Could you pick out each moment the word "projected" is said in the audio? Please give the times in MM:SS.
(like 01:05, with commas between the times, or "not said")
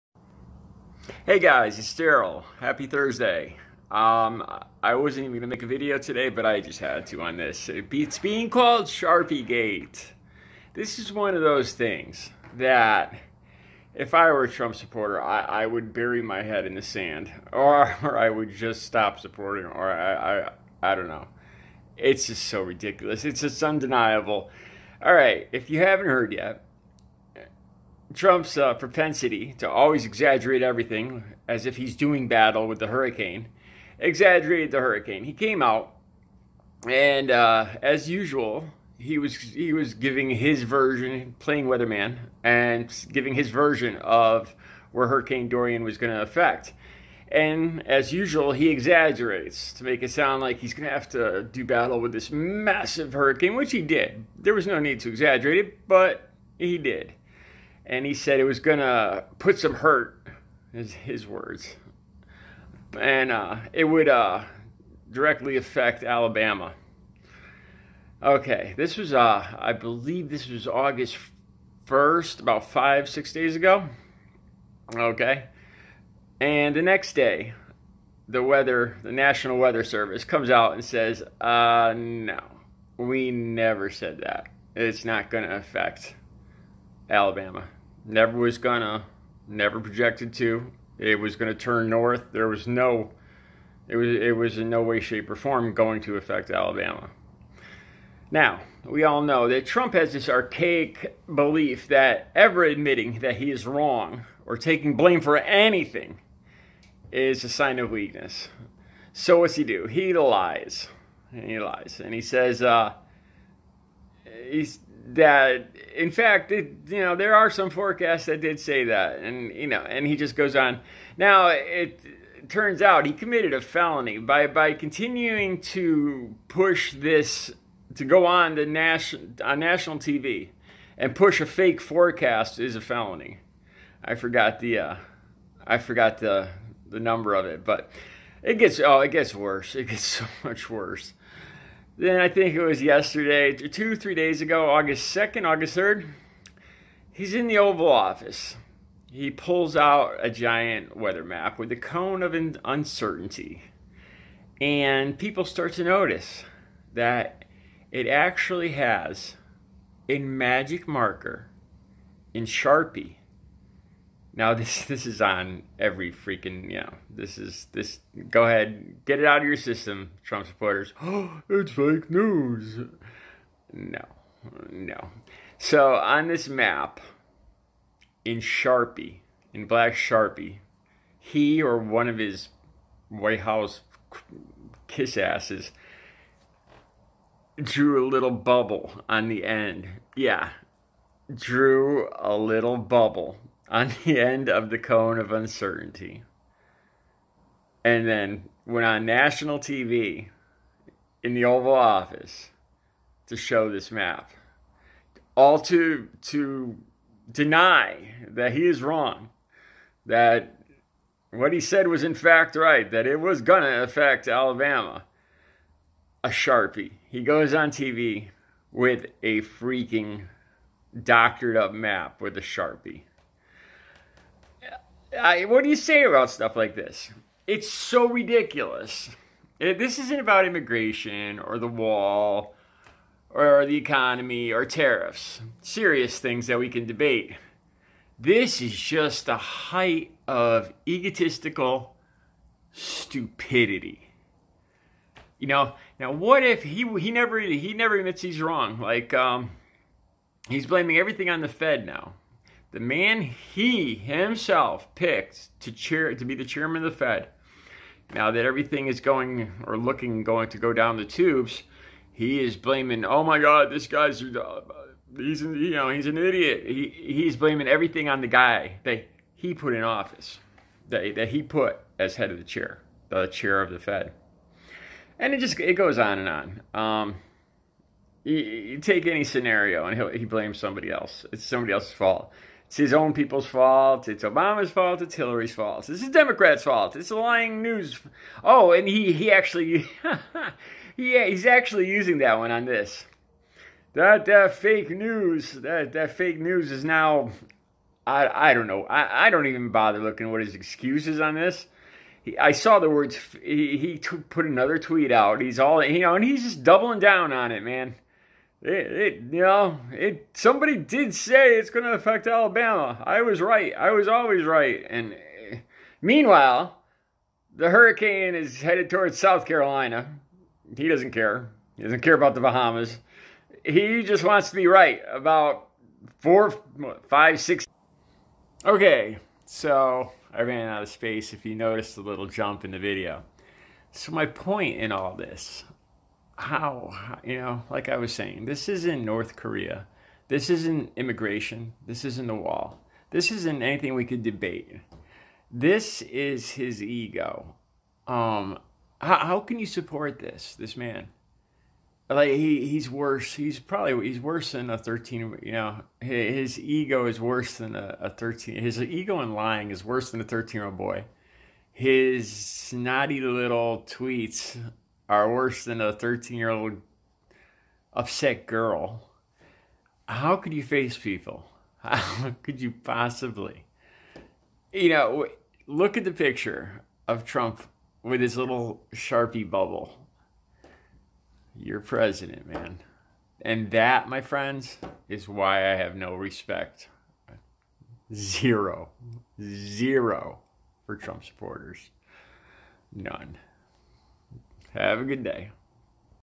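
01:29.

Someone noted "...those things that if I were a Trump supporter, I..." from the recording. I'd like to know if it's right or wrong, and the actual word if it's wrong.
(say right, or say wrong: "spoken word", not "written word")
right.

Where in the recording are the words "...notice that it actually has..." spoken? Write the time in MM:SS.
02:35.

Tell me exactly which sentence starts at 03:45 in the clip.
I, what do you say about stuff like this?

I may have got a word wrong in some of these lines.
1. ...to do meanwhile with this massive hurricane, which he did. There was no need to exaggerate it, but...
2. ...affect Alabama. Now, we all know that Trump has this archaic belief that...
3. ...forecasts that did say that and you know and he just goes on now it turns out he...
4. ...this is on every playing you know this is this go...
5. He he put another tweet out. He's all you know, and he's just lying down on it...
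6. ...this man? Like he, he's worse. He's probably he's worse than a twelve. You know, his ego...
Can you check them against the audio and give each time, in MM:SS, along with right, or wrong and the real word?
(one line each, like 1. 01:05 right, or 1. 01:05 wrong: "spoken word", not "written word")
1. 00:51 wrong: "battle", not "meanwhile"
2. 01:36 right
3. 01:57 right
4. 02:44 wrong: "freaking", not "playing"
5. 05:03 wrong: "doubling", not "lying"
6. 05:50 wrong: "thirteen", not "twelve".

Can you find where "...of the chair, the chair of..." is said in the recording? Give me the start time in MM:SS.
04:32.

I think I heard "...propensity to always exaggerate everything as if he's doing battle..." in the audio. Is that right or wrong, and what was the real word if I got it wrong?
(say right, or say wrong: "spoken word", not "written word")
right.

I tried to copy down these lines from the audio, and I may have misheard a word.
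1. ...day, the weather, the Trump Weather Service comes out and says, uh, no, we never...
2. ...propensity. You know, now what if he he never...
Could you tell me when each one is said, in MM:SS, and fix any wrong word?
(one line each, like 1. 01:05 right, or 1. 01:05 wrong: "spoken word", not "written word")
1. 01:17 wrong: "National", not "Trump"
2. 04:02 wrong: "stupidity", not "propensity".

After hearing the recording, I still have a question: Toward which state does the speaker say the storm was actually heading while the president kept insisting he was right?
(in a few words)
South Carolina.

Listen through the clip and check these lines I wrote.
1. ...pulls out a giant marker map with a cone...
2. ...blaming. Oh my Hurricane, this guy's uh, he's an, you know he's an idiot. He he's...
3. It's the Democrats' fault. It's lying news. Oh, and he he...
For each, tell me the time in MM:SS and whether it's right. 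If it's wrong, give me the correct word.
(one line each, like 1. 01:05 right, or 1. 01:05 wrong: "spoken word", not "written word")
1. 02:29 wrong: "weather", not "marker"
2. 04:22 wrong: "God", not "Hurricane"
3. 04:45 right.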